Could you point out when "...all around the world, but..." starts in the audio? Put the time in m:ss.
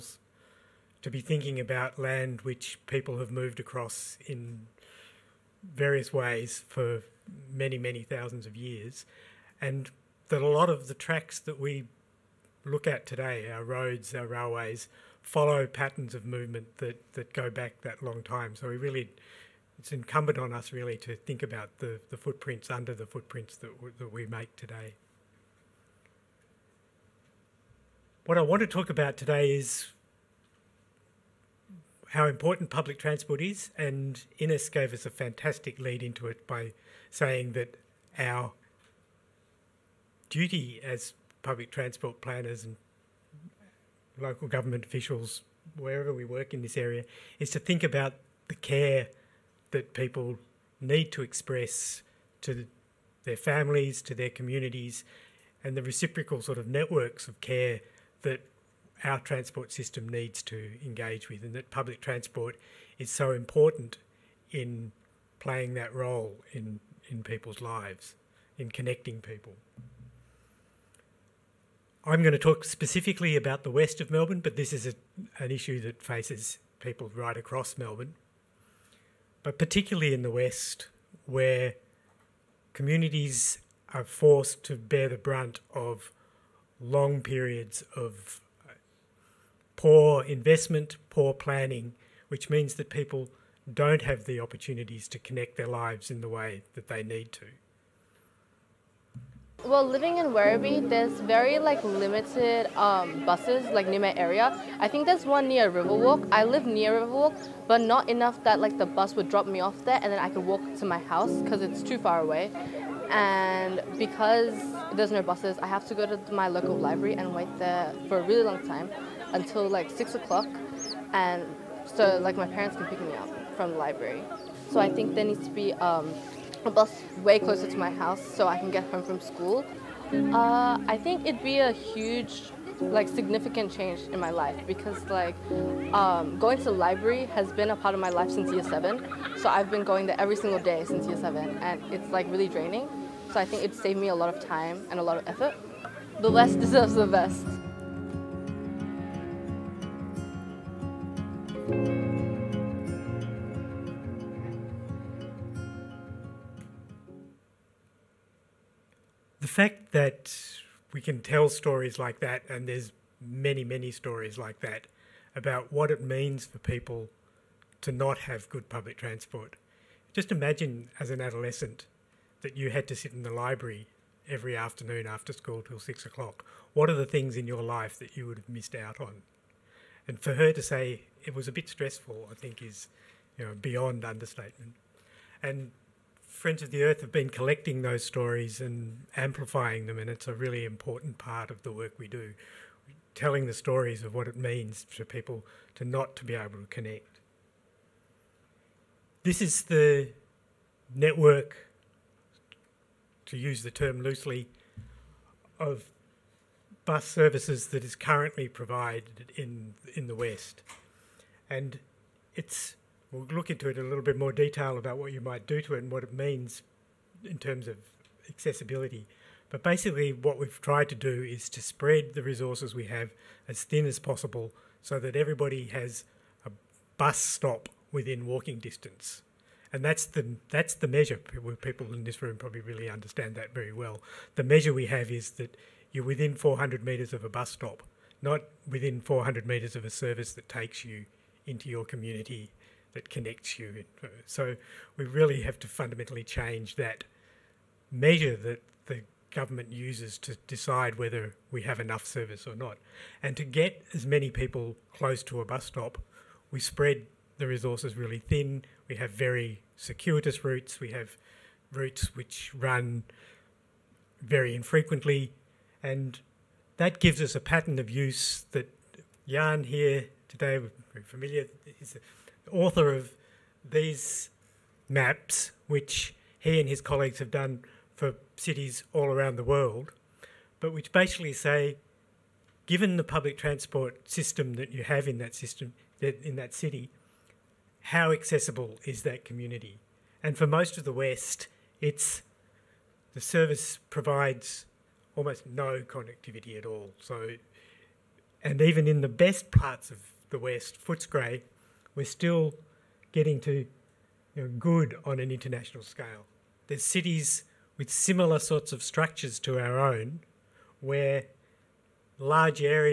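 4:38.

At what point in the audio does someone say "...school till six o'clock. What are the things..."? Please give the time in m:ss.
2:55.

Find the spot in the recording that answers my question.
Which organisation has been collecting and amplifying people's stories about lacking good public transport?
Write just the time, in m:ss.
3:06.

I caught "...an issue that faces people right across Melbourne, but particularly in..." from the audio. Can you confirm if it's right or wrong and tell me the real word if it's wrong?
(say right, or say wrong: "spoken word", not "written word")
right.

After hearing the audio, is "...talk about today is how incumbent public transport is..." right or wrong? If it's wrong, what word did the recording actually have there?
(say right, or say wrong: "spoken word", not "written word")
wrong: "important", not "incumbent".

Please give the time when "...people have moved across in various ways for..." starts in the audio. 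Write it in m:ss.
0:02.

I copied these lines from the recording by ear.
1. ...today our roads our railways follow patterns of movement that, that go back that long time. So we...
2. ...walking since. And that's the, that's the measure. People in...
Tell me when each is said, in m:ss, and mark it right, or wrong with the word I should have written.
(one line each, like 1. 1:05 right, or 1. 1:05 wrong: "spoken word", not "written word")
1. 0:13 right
2. 3:48 wrong: "distance", not "since".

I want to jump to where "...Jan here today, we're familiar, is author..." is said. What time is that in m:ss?
4:29.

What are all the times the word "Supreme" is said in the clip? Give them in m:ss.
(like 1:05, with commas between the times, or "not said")
not said.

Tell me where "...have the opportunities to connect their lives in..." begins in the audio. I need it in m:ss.
1:34.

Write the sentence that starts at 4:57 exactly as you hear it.
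So, and even in the best parts of the West, Footscray we're still getting to you know, good on an international scale.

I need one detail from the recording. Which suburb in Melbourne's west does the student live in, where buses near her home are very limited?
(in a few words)
Werribee.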